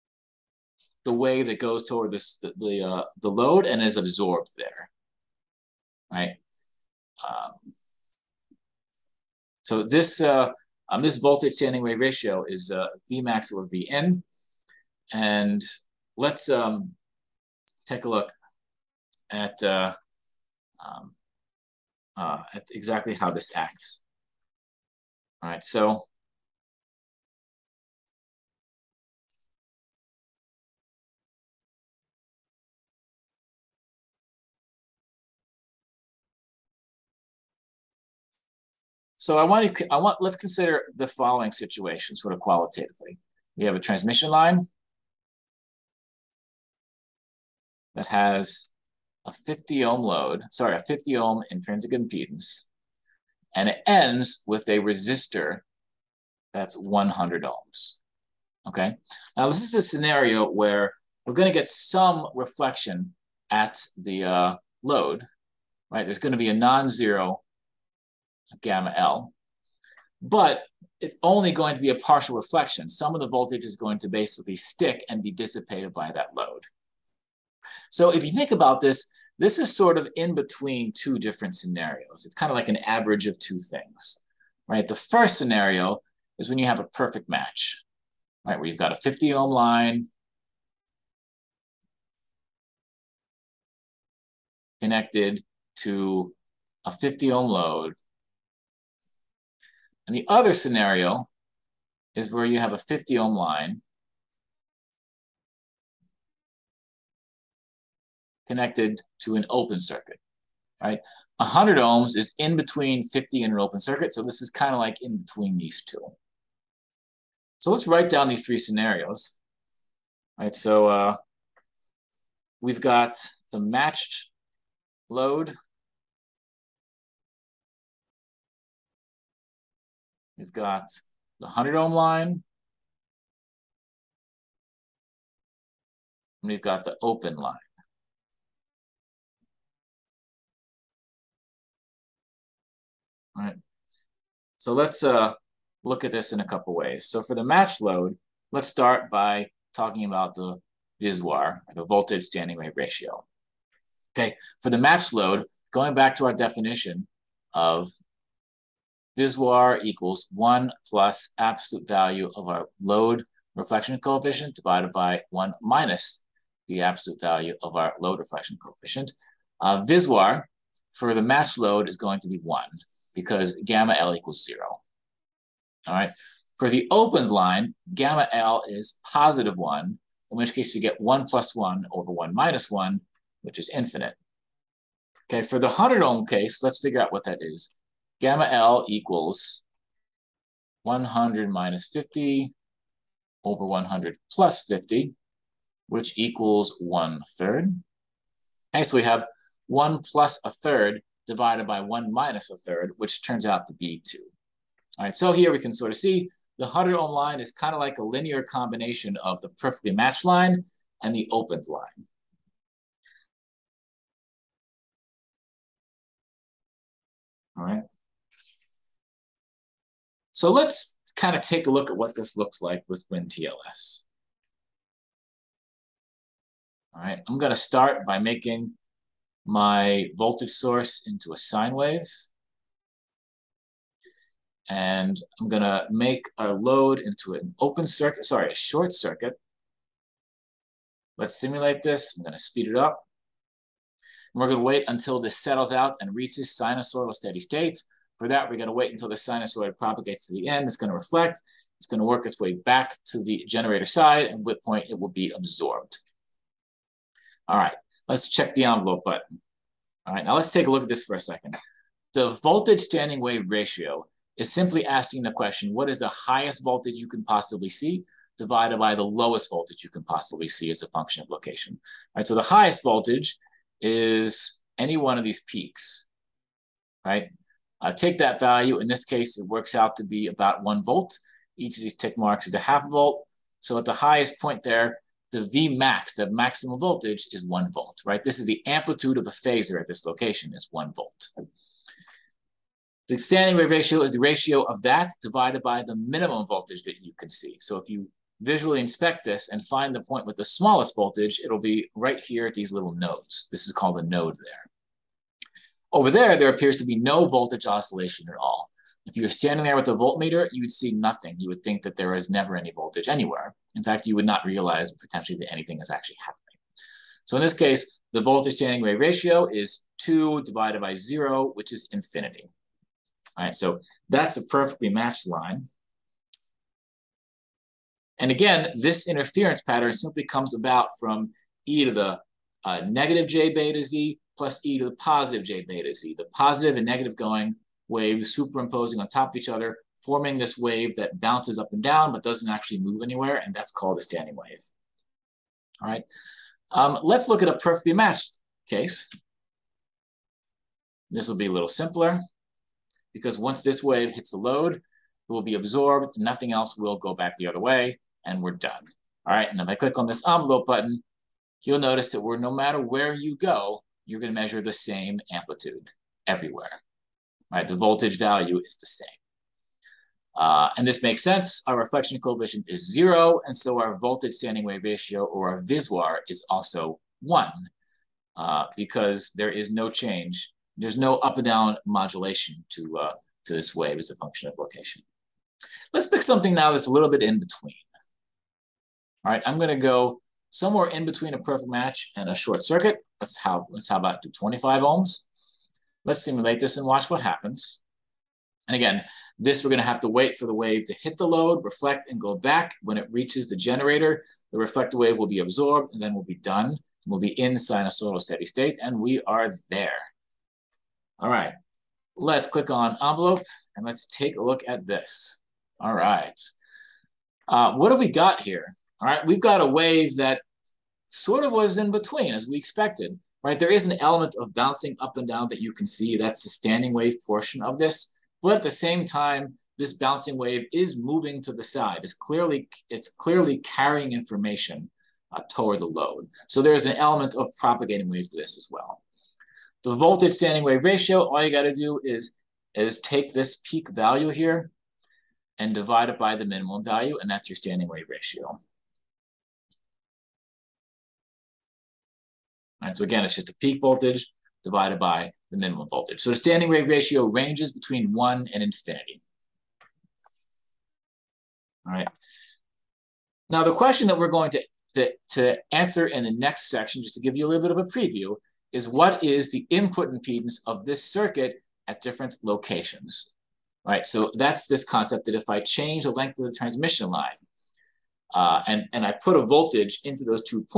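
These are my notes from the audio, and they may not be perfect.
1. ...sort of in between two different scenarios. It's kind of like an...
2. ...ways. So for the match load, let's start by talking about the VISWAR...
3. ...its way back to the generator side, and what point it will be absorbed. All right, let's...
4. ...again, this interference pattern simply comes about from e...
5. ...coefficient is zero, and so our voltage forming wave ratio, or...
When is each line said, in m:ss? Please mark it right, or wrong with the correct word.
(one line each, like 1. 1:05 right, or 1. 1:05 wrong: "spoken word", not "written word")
1. 1:19 right
2. 2:26 right
3. 4:12 right
4. 5:28 right
5. 6:12 wrong: "standing", not "forming".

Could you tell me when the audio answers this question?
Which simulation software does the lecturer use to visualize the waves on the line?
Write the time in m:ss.
3:43.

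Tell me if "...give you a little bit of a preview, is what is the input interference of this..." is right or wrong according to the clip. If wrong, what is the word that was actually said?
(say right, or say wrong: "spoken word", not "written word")
wrong: "impedance", not "interference".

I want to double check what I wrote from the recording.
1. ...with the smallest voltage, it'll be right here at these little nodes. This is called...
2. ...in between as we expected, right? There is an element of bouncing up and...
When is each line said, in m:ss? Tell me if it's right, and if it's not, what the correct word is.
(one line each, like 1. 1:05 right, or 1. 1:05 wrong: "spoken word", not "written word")
1. 5:00 right
2. 7:01 right.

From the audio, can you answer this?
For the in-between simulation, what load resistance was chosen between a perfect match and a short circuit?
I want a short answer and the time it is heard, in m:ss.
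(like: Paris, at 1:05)
25 ohms, at 6:34.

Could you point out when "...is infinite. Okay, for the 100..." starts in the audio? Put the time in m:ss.
3:03.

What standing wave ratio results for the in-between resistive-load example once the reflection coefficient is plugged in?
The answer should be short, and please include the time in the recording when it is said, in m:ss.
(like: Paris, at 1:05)
2, at 3:22.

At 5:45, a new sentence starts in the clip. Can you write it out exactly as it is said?
All right, um, let's look at a perfectly matched case.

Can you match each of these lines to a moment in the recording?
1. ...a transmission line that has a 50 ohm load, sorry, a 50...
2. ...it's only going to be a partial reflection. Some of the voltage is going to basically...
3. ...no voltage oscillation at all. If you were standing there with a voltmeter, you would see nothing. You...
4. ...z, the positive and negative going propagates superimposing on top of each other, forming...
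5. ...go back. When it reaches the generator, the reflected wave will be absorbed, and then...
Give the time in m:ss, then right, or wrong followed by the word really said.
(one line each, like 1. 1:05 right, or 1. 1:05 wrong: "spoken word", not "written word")
1. 0:43 right
2. 1:10 right
3. 5:06 right
4. 5:35 wrong: "waves", not "propagates"
5. 6:42 right.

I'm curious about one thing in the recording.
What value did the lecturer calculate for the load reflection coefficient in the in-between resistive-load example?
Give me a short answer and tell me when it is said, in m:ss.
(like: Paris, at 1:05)
1/3, at 3:16.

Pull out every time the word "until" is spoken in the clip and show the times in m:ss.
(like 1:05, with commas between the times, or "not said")
4:04, 4:08.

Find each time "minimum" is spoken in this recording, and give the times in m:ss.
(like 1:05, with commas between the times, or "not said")
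4:55, 7:26, 7:35.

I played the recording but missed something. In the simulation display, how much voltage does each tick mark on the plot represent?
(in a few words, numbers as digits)
half volt.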